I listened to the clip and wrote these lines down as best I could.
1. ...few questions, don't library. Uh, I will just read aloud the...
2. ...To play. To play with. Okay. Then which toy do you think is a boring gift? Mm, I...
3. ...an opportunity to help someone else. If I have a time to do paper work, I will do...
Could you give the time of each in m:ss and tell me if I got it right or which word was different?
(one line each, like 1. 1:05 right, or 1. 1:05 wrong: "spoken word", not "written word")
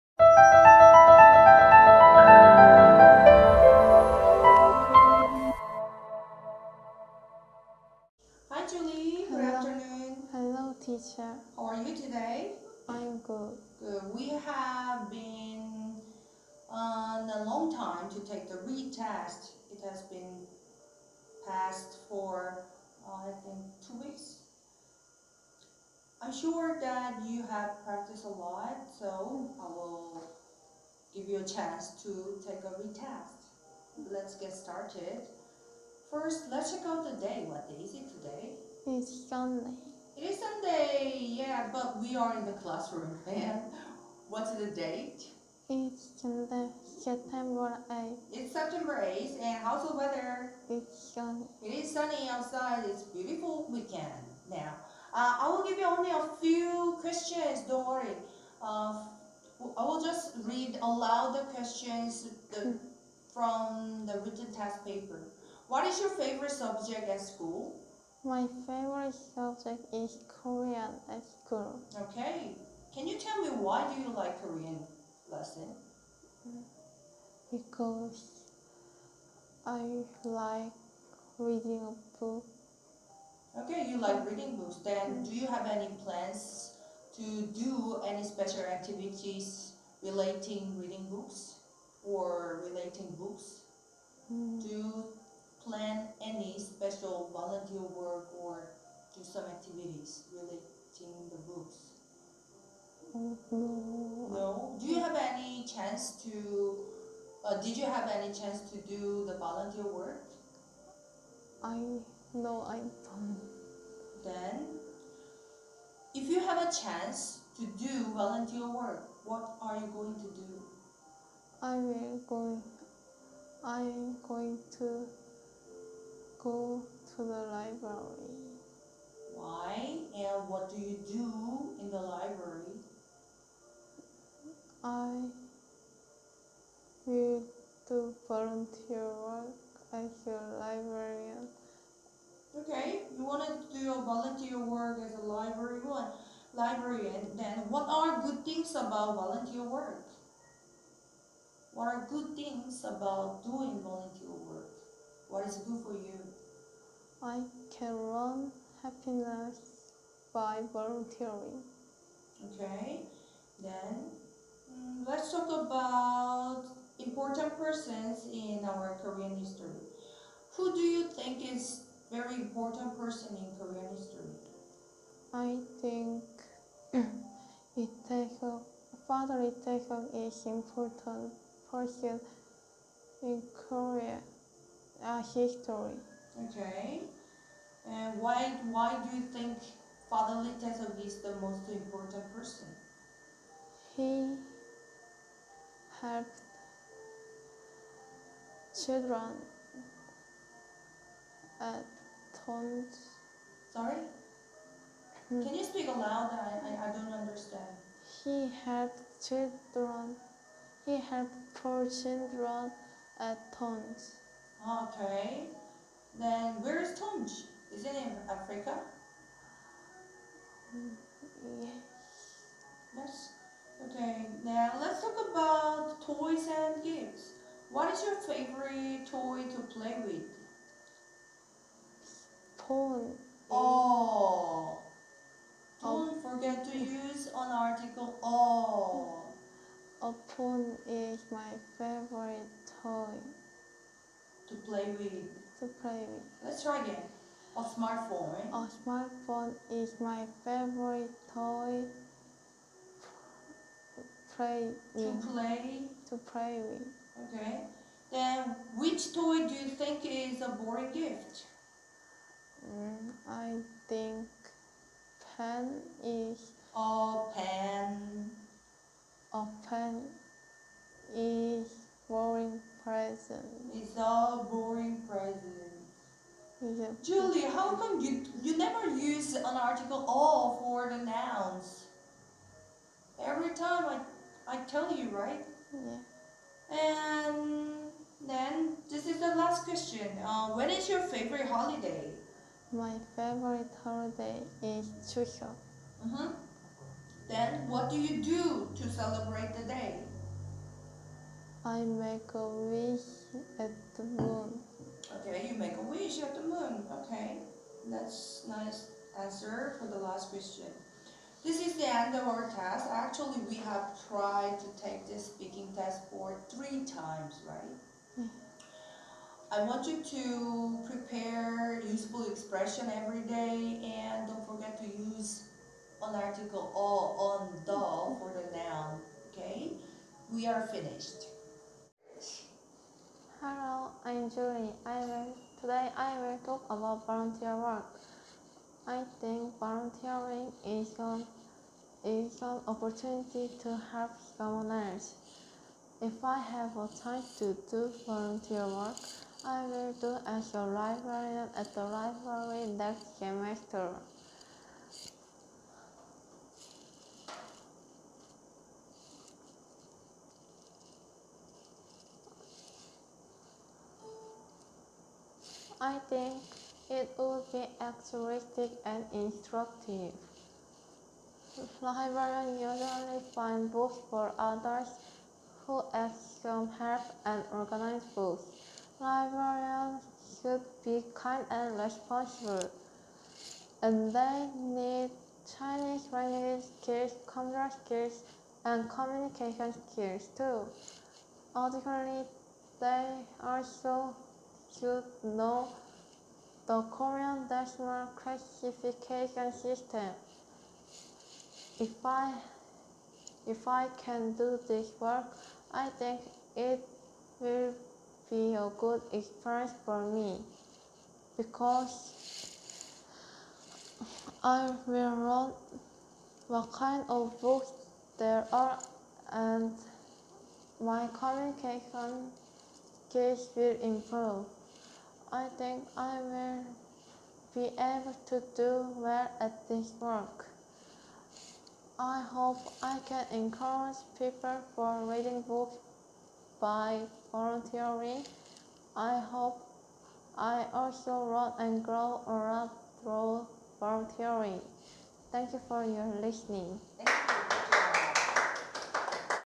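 1. 0:56 wrong: "worry", not "library"
2. 4:14 right
3. 5:42 wrong: "volunteer", not "paper".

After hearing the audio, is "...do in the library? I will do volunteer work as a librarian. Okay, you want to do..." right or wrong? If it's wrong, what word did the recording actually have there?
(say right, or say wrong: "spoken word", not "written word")
right.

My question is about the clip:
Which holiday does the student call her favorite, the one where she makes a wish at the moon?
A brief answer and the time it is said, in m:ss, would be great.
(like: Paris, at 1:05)
Chuseok, at 4:55.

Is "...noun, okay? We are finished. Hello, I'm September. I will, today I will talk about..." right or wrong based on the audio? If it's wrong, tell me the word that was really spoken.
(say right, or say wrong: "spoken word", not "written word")
wrong: "Julie", not "September".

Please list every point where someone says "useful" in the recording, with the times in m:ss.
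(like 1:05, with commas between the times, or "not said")
5:21.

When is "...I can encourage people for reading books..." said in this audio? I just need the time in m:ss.
7:12.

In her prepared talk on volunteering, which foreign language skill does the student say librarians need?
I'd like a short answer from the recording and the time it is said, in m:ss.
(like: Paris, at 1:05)
Chinese, at 6:25.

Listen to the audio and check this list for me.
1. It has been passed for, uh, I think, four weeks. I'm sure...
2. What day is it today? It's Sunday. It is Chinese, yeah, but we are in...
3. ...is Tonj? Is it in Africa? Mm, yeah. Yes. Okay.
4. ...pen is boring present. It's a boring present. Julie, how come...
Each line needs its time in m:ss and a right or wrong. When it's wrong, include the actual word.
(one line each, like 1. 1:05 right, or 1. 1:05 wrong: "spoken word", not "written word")
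1. 0:19 wrong: "two", not "four"
2. 0:37 wrong: "Sunday", not "Chinese"
3. 3:36 right
4. 4:29 right.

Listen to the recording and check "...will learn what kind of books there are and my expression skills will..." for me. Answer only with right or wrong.
wrong.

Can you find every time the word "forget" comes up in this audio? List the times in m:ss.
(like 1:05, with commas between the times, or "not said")
3:56, 5:24.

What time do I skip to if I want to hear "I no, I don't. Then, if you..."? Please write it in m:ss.
1:51.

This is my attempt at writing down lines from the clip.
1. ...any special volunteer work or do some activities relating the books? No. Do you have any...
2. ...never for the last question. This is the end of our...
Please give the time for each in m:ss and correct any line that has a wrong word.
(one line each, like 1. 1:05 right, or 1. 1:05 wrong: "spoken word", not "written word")
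1. 1:36 right
2. 5:09 wrong: "answer", not "never".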